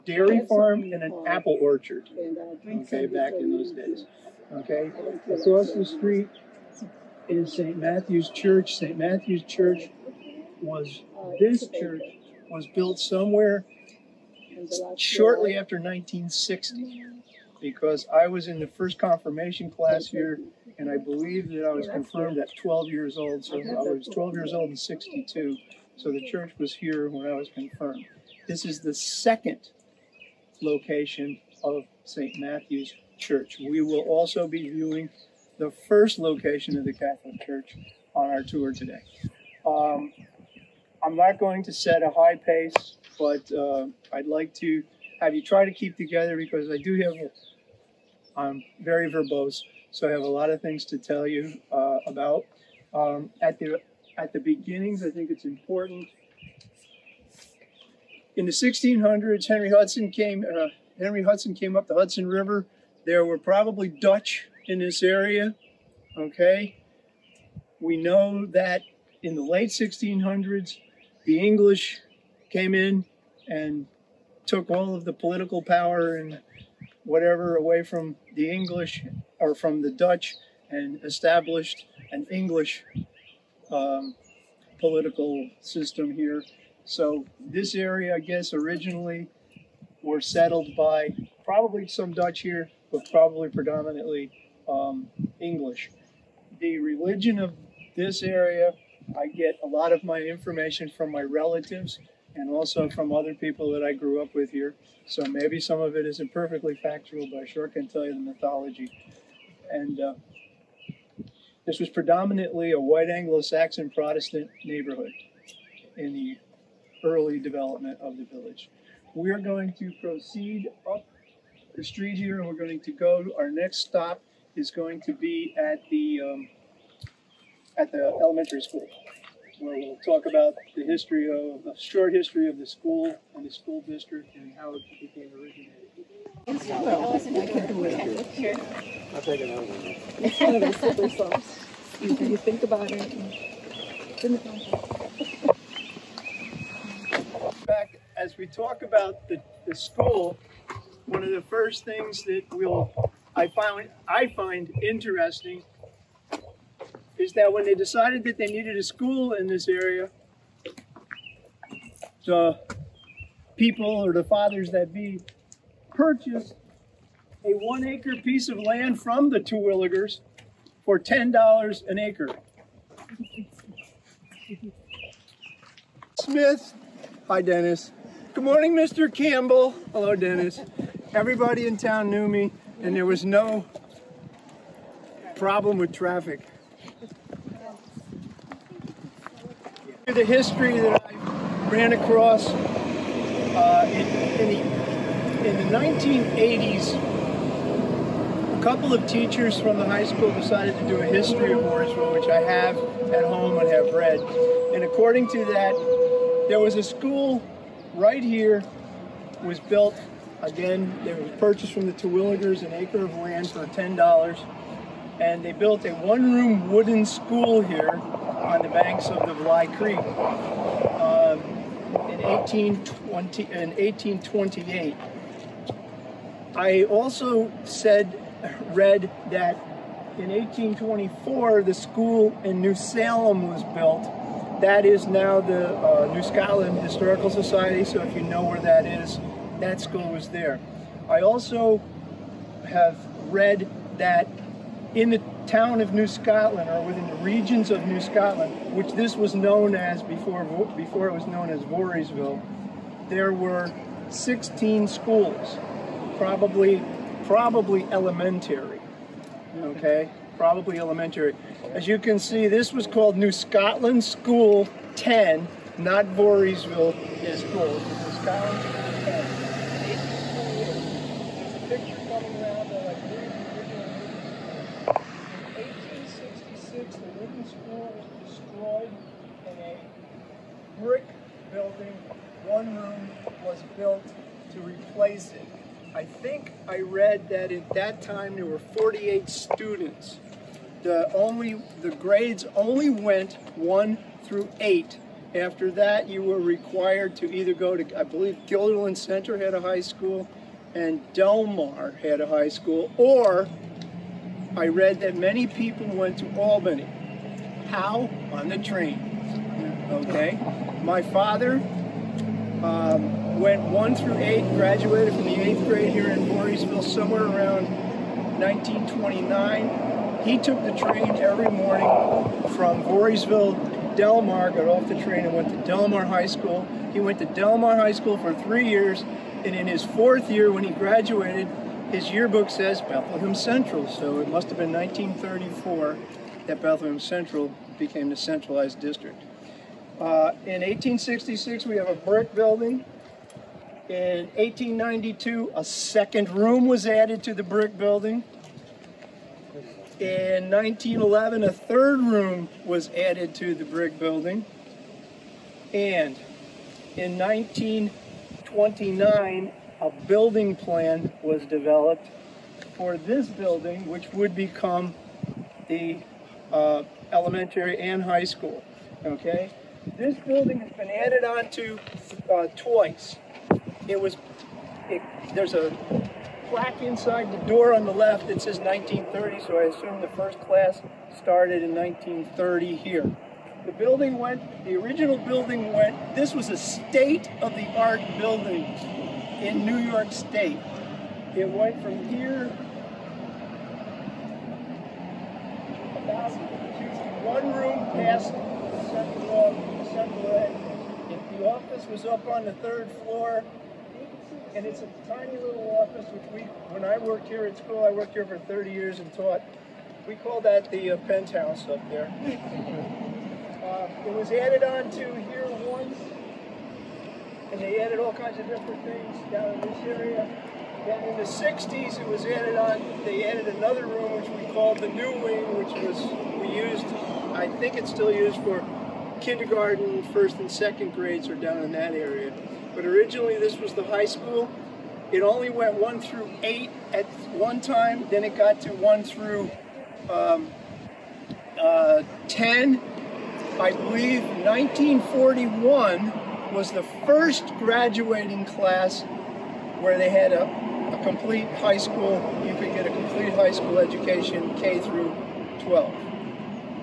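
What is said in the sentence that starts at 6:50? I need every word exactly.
We call that the uh, penthouse up there.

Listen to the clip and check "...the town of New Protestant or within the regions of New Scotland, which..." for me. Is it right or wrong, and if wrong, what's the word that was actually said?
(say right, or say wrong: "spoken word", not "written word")
wrong: "Scotland", not "Protestant".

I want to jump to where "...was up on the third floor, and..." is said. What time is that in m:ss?
6:41.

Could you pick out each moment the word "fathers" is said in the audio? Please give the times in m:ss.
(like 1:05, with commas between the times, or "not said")
2:44, 5:11.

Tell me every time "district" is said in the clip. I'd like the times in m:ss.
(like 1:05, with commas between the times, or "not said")
2:13, 5:38.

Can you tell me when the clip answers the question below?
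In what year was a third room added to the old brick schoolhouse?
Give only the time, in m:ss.
5:50.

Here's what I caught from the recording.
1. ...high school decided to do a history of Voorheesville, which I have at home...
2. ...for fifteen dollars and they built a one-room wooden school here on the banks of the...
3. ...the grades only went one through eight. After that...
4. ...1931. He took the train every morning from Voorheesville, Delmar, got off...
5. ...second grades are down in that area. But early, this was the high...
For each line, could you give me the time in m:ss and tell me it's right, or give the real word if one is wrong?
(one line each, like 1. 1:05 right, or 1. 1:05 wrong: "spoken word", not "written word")
1. 3:19 right
2. 3:33 wrong: "ten", not "fifteen"
3. 4:51 right
4. 5:18 wrong: "1929", not "1931"
5. 7:10 wrong: "originally", not "early".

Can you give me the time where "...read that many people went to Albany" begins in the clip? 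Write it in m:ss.
5:04.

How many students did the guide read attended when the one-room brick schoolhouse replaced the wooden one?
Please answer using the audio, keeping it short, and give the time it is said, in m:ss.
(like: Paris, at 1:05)
48, at 4:48.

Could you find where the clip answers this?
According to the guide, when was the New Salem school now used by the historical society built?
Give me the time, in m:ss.
3:50.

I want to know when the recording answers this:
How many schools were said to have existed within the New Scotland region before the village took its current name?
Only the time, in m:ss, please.
4:14.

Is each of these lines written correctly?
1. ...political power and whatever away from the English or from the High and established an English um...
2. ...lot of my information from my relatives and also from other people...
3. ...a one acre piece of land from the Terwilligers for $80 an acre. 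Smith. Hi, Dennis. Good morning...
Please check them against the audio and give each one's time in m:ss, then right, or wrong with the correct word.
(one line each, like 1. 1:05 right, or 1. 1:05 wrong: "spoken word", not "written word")
1. 1:15 wrong: "Dutch", not "High"
2. 1:39 right
3. 2:47 wrong: "10", not "80".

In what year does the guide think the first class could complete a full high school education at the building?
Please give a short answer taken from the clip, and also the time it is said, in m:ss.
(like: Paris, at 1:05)
1941, at 7:24.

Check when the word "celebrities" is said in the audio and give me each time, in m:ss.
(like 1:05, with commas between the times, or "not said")
not said.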